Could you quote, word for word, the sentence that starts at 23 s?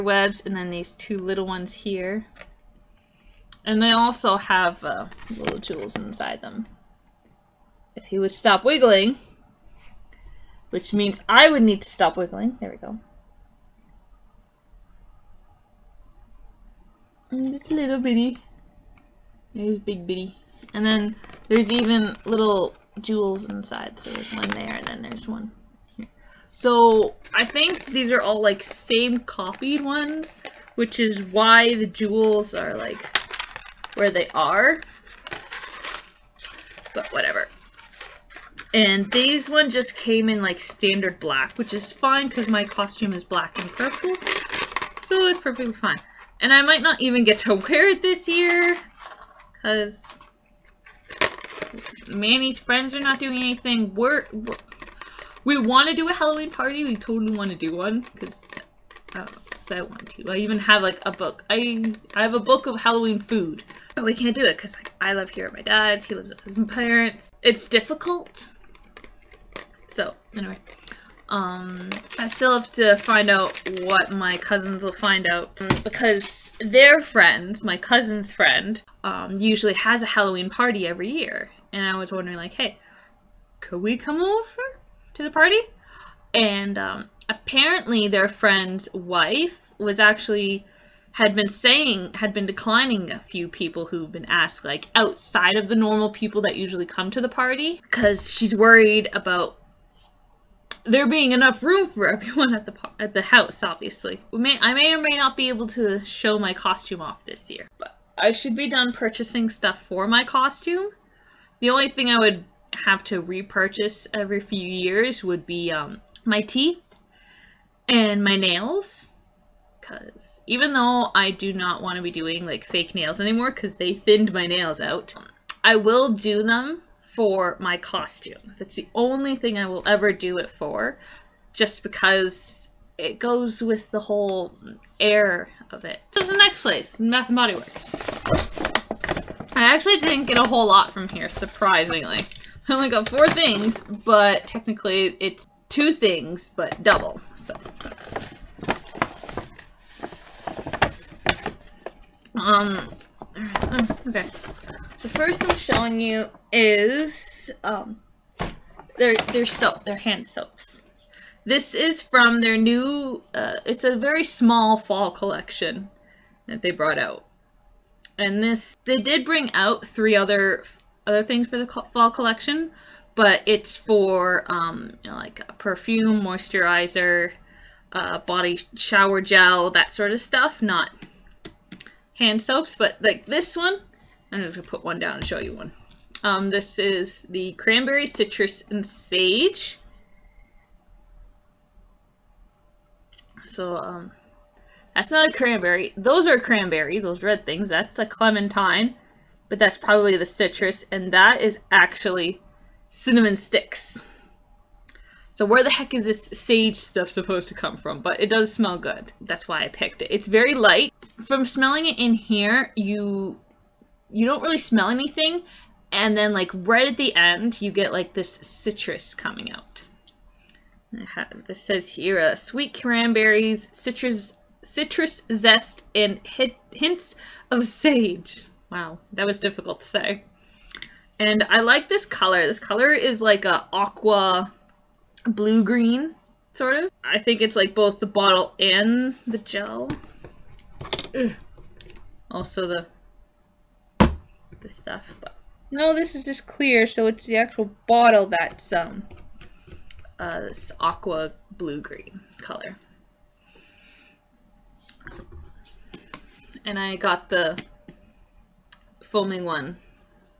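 So there's one there, and then there's one here.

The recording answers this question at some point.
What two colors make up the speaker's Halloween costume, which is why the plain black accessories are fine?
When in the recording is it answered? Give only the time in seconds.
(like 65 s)
43 s.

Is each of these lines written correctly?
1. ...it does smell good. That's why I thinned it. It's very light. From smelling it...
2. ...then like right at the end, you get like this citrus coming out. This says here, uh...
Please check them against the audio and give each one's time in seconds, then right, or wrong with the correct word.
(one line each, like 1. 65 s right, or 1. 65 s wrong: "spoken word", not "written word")
1. 208 s wrong: "picked", not "thinned"
2. 216 s right.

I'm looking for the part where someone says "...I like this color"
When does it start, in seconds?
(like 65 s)
231 s.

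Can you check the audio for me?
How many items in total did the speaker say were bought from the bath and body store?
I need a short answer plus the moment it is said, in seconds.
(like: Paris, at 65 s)
4, at 143 s.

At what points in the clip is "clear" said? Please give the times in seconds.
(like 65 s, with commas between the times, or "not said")
246 s.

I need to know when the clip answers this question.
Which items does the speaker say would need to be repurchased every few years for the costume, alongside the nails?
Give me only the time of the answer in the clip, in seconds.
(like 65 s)
116 s.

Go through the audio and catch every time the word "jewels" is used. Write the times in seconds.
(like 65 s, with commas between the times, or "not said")
5 s, 22 s, 31 s.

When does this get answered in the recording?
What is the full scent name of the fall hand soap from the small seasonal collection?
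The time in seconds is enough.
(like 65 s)
187 s.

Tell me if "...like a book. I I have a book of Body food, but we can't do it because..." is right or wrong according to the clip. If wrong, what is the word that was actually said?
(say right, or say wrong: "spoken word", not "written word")
wrong: "Halloween", not "Body".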